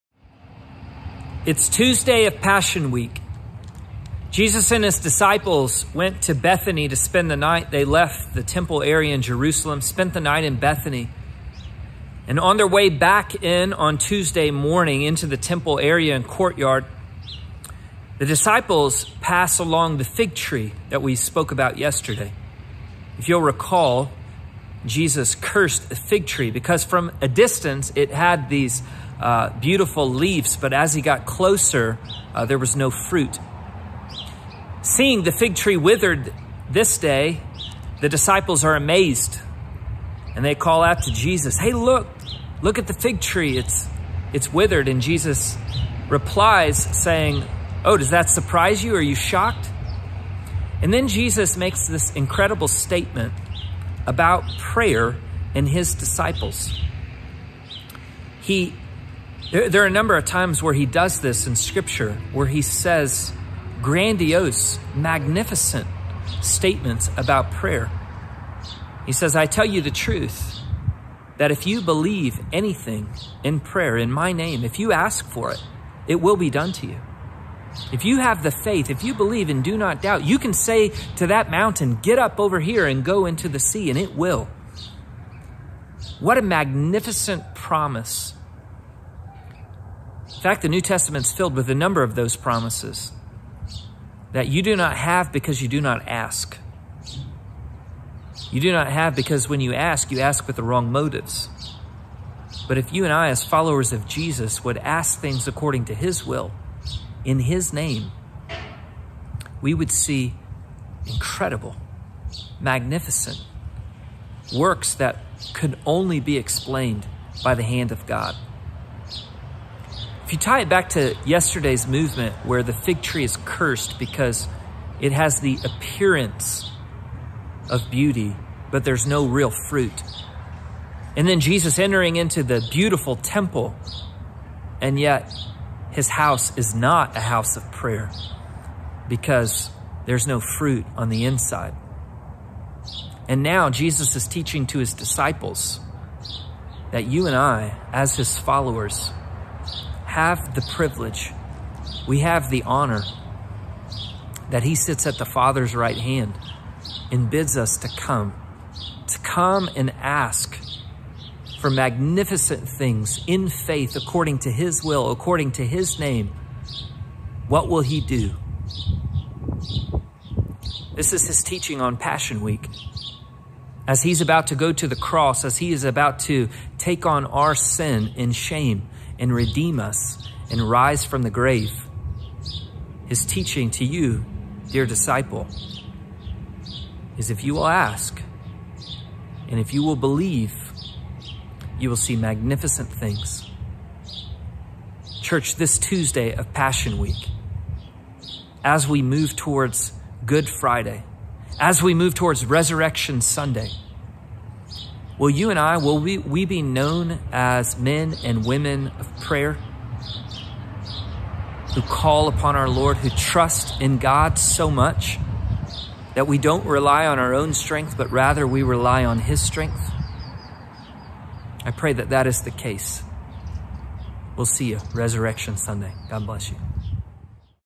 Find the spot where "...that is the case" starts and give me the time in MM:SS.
03:42.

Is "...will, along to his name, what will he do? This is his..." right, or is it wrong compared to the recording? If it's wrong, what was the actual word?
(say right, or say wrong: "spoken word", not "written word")
wrong: "according", not "along".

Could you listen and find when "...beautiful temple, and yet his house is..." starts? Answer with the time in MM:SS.
02:12.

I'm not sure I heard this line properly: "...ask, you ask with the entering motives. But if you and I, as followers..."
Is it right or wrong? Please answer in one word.
wrong.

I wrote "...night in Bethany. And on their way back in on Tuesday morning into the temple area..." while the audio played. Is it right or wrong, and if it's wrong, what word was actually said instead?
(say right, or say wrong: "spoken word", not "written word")
right.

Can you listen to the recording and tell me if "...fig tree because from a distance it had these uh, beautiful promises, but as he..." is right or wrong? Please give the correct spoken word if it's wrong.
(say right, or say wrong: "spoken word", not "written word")
wrong: "leaves", not "promises".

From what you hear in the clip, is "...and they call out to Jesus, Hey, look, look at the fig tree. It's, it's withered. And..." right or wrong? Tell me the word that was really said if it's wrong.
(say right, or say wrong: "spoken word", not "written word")
right.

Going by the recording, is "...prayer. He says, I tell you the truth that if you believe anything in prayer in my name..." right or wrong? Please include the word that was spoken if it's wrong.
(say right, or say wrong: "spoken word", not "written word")
right.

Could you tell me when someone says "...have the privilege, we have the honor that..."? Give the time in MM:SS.
02:30.